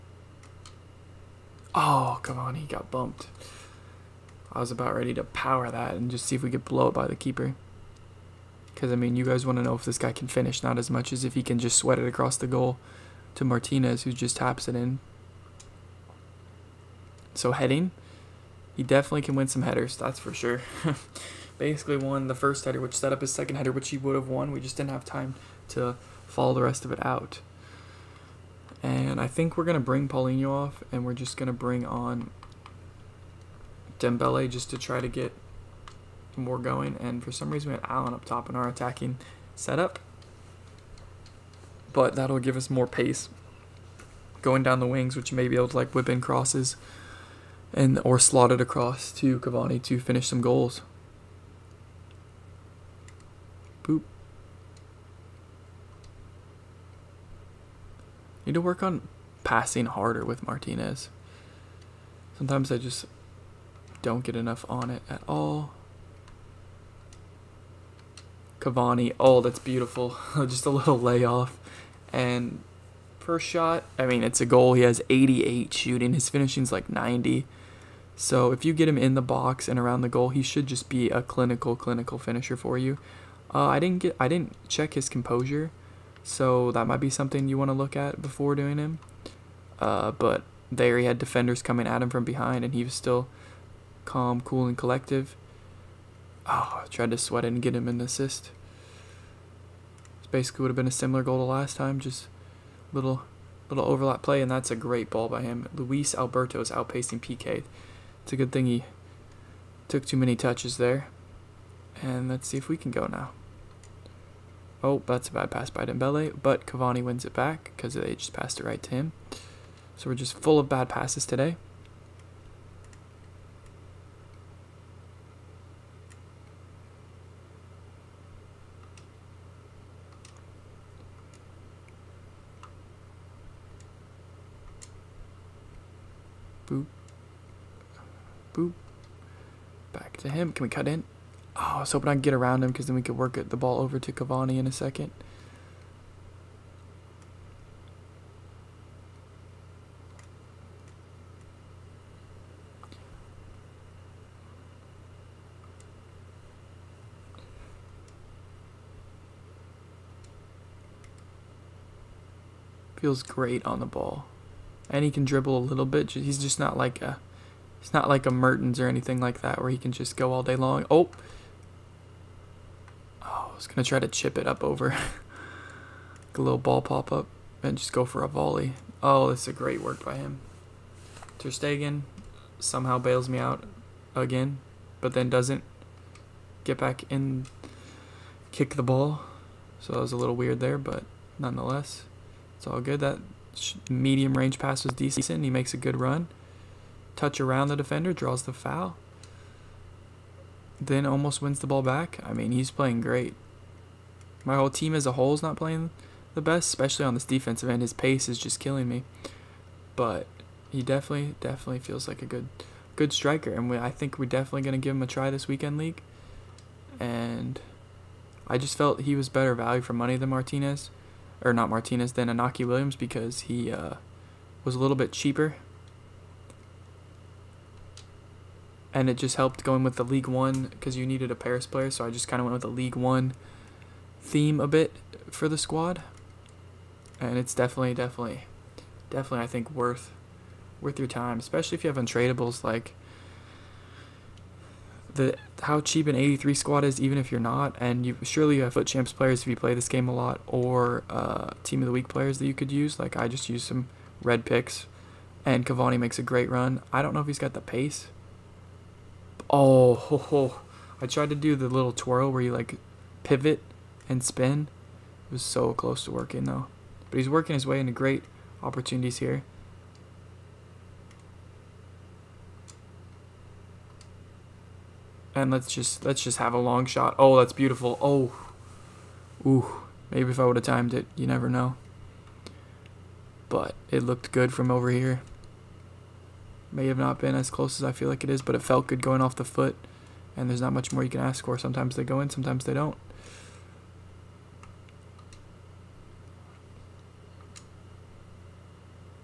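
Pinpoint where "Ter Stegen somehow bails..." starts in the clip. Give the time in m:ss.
3:01.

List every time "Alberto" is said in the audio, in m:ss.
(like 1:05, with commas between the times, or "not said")
1:46.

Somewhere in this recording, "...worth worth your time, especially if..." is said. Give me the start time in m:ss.
3:59.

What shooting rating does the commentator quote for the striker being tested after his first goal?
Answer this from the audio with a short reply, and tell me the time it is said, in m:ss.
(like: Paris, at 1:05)
88, at 1:15.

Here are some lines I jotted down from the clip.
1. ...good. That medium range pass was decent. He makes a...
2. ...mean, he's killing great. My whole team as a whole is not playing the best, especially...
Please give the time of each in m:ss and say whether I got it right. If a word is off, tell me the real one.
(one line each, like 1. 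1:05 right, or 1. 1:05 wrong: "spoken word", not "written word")
1. 3:12 right
2. 3:22 wrong: "playing", not "killing".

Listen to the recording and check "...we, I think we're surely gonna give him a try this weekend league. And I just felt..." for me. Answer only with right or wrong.
wrong.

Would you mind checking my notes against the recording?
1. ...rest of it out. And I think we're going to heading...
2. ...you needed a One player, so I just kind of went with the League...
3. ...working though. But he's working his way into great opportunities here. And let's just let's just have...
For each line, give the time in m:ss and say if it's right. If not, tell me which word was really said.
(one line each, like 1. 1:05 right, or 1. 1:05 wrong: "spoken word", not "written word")
1. 0:26 wrong: "bring", not "heading"
2. 3:50 wrong: "Paris", not "One"
3. 4:26 right.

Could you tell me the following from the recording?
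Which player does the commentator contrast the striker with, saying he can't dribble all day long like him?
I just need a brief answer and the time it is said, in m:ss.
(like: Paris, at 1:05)
Mertens, at 2:48.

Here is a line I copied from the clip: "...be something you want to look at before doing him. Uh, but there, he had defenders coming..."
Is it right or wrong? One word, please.
right.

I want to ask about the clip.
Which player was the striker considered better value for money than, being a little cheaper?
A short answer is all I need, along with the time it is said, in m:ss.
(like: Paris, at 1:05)
Iñaki Williams, at 3:42.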